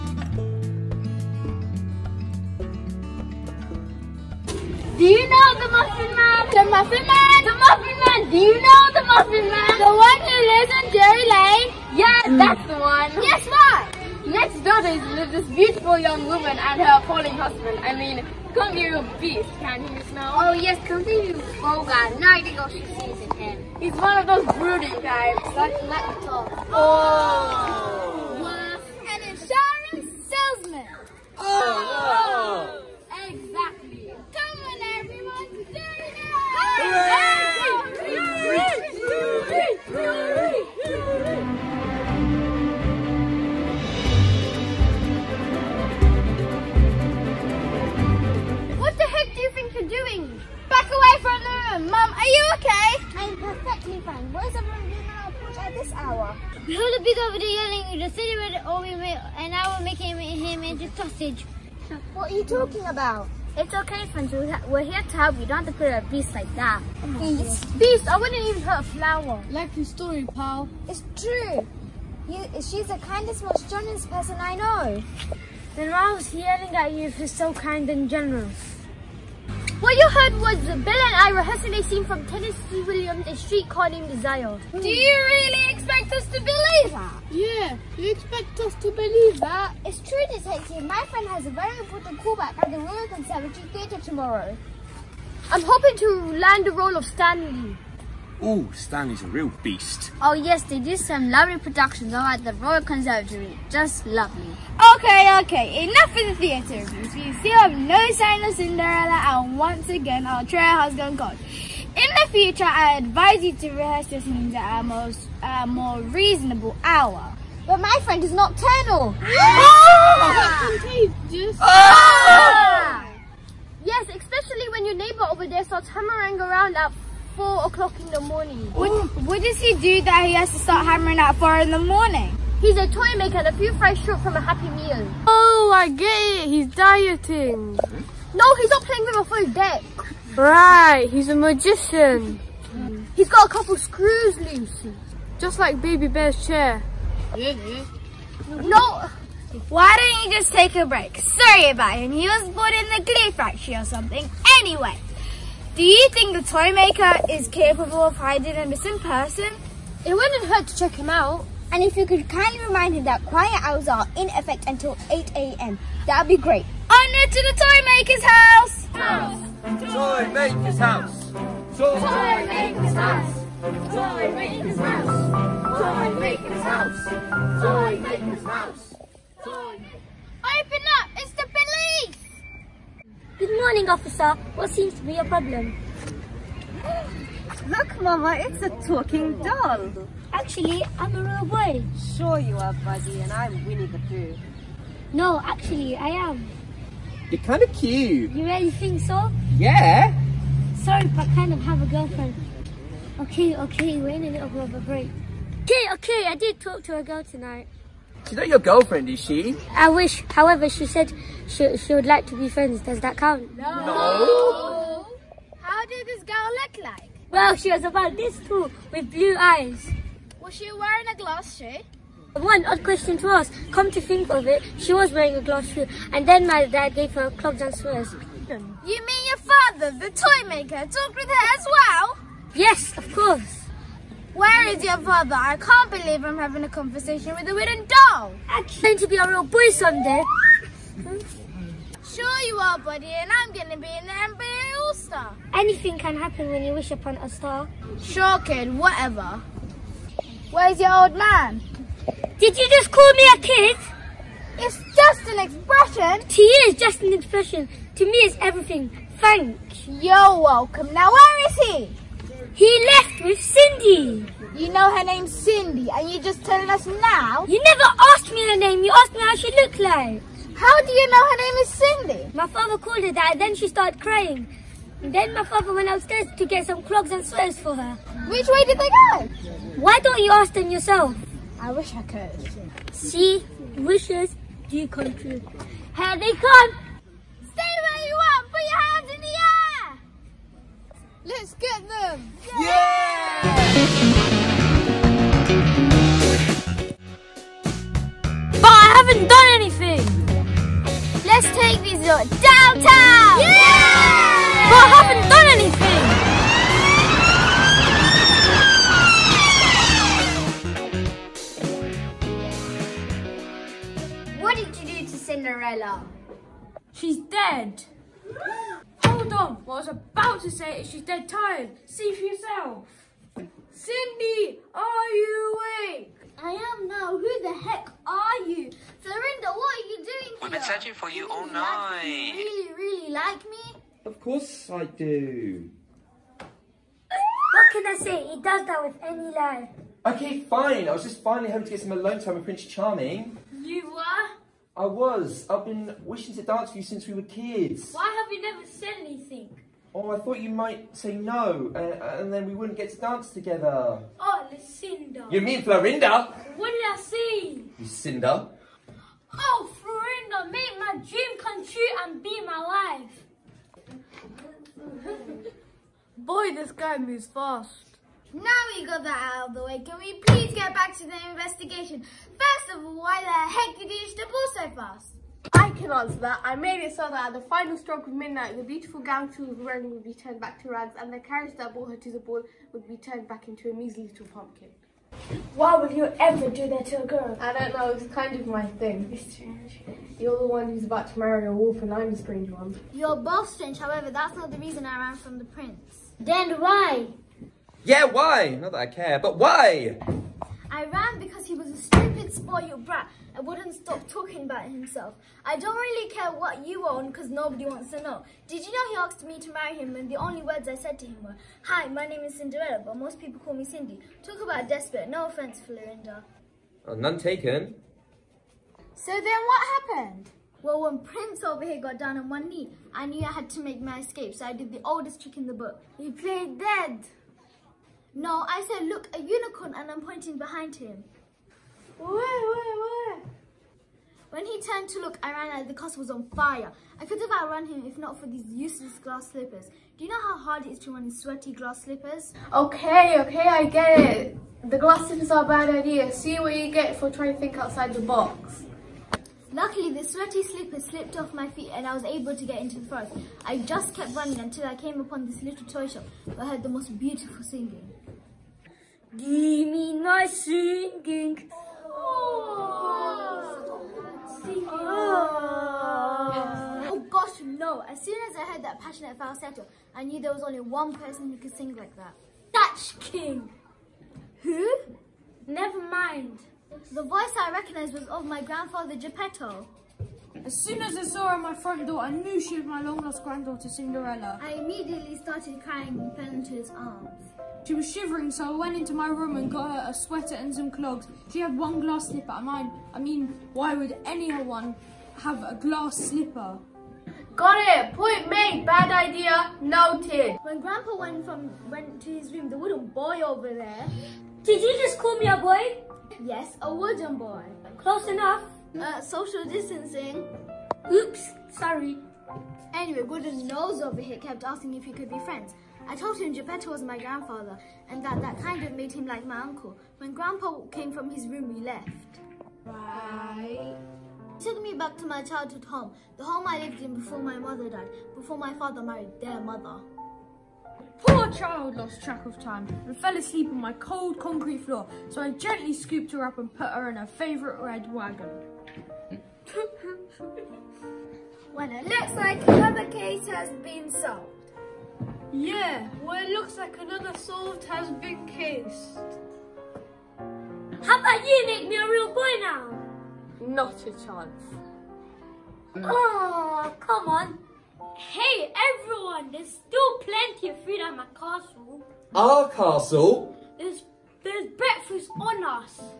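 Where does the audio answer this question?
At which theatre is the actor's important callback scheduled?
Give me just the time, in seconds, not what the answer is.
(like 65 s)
92 s.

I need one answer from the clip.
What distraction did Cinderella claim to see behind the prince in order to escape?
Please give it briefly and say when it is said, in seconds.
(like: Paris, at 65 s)
A unicorn, at 429 s.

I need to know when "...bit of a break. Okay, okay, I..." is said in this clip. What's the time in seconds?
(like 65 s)
204 s.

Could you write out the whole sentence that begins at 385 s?
Why would you ever do that to a girl?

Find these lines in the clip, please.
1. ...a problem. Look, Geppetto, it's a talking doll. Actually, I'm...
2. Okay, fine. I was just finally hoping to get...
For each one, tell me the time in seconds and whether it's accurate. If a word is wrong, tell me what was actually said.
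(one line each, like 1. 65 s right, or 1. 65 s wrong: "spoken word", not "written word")
1. 185 s wrong: "Mama", not "Geppetto"
2. 340 s right.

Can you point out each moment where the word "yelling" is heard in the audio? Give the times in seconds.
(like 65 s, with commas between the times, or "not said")
57 s, 76 s.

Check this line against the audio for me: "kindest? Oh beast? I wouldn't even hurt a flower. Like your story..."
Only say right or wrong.
wrong.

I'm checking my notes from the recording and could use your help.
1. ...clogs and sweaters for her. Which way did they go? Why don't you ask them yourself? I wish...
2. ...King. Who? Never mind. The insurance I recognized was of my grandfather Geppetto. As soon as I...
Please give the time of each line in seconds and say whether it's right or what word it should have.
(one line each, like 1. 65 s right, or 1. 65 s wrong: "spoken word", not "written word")
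1. 276 s right
2. 473 s wrong: "voice", not "insurance".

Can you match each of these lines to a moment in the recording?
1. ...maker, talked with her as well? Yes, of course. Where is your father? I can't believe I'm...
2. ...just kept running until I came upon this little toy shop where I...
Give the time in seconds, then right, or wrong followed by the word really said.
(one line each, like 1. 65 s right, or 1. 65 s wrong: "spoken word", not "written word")
1. 230 s right
2. 453 s right.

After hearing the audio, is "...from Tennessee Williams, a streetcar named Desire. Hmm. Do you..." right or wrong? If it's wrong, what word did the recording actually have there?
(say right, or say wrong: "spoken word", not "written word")
right.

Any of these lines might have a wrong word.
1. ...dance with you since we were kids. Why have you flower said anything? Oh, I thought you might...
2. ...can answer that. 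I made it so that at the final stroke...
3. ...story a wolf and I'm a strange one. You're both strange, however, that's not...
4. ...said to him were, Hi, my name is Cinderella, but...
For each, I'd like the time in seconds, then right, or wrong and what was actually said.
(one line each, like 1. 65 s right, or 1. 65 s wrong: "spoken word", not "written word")
1. 346 s wrong: "never", not "flower"
2. 375 s right
3. 391 s wrong: "marry", not "story"
4. 410 s right.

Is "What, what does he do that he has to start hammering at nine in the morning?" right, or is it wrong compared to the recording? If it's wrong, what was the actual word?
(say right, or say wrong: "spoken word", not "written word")
wrong: "four", not "nine".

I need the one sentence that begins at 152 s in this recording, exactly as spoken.
He was born in the Glee factory or something.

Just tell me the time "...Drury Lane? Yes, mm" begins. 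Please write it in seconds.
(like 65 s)
10 s.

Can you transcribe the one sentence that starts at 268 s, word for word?
You asked me how she looked like.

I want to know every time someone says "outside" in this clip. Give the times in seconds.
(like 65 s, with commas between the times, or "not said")
447 s.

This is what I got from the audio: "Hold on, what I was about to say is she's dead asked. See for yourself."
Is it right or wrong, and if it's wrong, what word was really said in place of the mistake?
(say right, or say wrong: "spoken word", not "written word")
wrong: "tired", not "asked".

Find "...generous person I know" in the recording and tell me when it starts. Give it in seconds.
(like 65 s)
73 s.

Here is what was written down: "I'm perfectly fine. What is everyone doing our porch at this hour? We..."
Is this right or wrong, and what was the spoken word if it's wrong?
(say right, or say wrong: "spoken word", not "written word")
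right.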